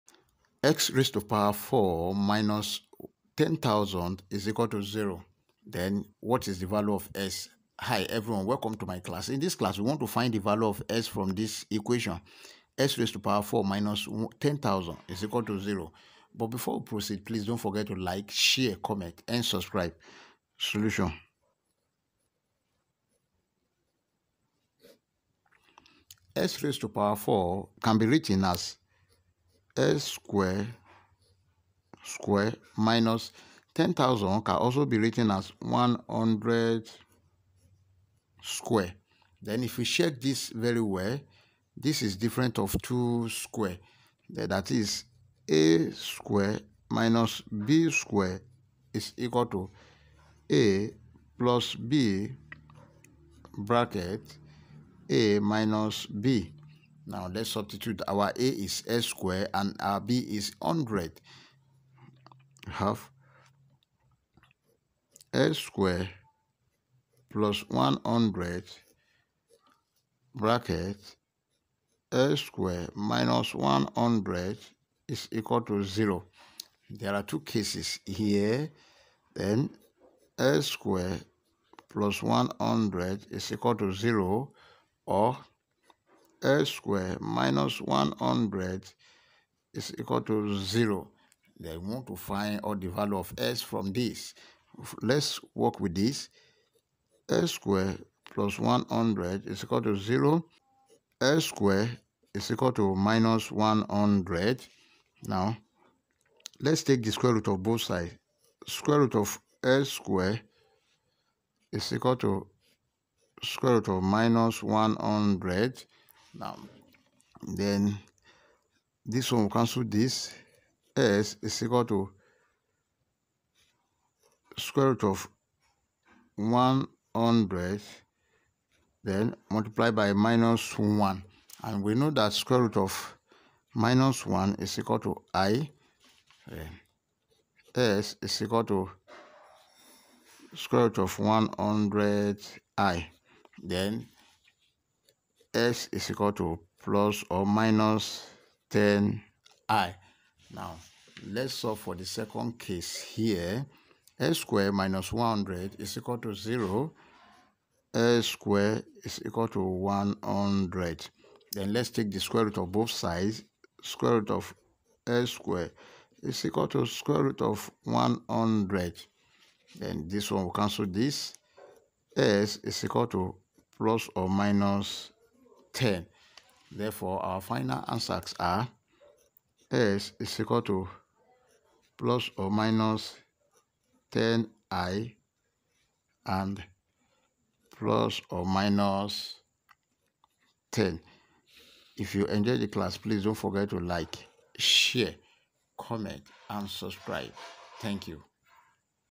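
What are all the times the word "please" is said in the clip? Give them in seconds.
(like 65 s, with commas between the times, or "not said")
17 s, 192 s.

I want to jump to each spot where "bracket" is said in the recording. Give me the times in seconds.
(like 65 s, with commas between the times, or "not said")
53 s, 70 s.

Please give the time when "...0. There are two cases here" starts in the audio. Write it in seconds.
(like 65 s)
75 s.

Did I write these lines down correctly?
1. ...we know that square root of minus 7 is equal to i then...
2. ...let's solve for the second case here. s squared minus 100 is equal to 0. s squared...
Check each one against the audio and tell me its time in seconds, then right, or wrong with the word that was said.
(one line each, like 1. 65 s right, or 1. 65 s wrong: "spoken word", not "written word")
1. 131 s wrong: "1", not "7"
2. 151 s right.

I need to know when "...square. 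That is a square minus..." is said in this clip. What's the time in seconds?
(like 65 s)
43 s.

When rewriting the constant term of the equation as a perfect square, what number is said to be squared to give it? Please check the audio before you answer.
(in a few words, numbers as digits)
100.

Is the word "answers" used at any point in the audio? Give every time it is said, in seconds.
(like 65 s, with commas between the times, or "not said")
177 s.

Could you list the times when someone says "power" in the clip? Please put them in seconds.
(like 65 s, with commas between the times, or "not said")
1 s, 13 s, 26 s.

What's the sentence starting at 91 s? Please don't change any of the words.
Then we want to find all the value of S from this.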